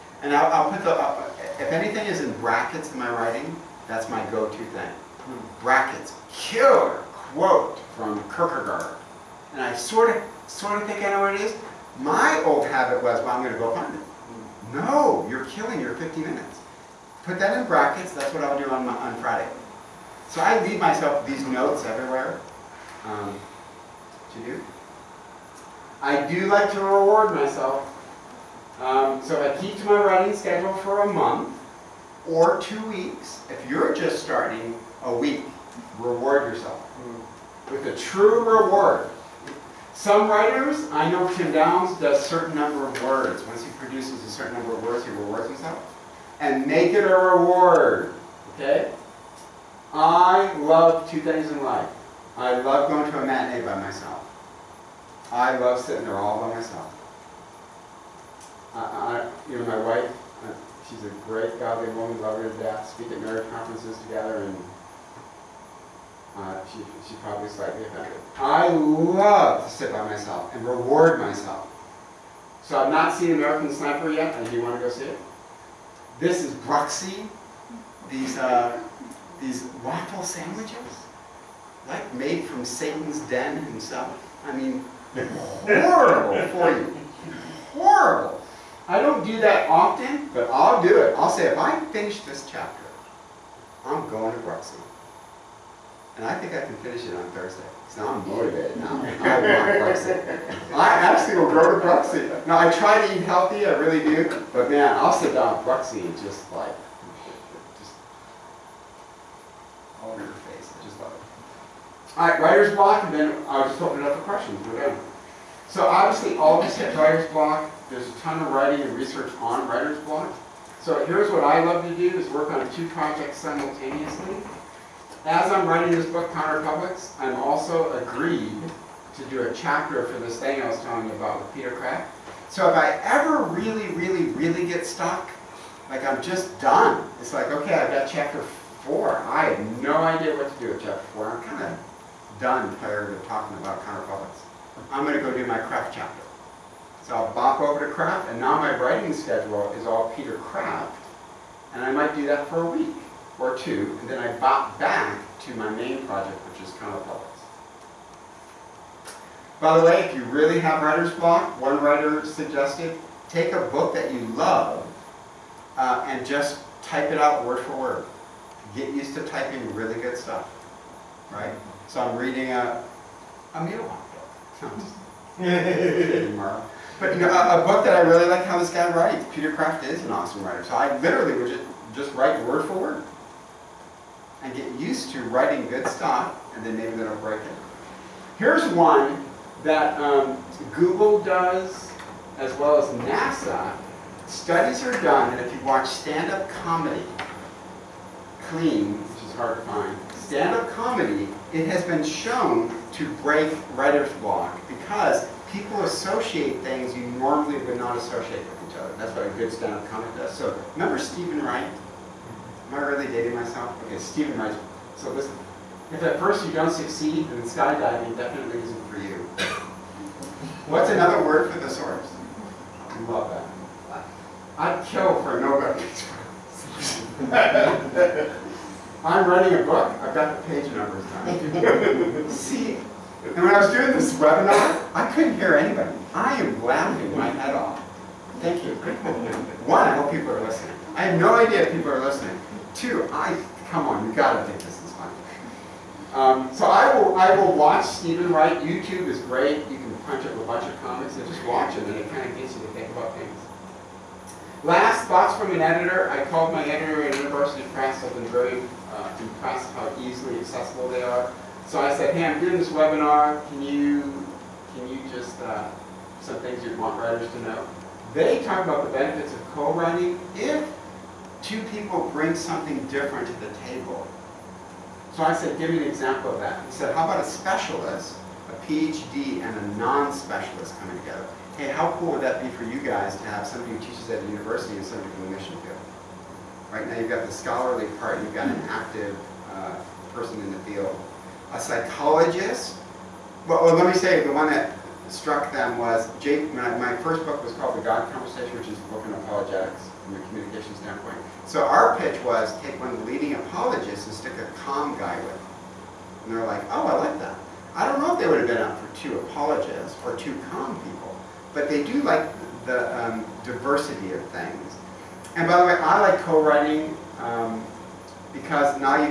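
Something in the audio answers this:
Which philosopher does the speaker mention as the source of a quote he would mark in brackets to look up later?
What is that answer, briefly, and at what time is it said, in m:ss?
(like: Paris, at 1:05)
Kierkegaard, at 0:08.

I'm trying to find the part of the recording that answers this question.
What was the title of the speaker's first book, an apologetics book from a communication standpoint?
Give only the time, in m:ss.
4:57.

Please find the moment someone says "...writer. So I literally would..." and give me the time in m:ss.
3:00.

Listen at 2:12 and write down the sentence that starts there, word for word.
So if I ever really, really, really get stuck, like I'm just done.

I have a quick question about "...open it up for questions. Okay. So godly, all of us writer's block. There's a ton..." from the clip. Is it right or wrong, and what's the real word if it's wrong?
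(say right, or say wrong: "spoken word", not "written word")
wrong: "obviously", not "godly".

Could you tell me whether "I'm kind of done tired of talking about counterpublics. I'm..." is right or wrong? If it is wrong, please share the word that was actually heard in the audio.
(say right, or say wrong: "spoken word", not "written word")
right.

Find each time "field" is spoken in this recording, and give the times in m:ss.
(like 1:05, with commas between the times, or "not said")
4:45, 4:50.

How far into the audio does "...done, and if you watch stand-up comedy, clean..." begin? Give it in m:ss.
3:15.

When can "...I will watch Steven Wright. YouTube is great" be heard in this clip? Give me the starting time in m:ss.
4:07.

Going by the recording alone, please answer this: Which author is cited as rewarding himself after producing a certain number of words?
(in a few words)
Tim Downs.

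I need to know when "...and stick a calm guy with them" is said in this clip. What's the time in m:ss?
5:04.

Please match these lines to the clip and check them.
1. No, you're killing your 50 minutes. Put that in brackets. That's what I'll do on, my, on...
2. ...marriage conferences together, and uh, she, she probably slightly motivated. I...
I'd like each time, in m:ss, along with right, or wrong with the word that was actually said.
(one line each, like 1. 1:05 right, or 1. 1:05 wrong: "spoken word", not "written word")
1. 0:14 right
2. 1:03 wrong: "offended", not "motivated".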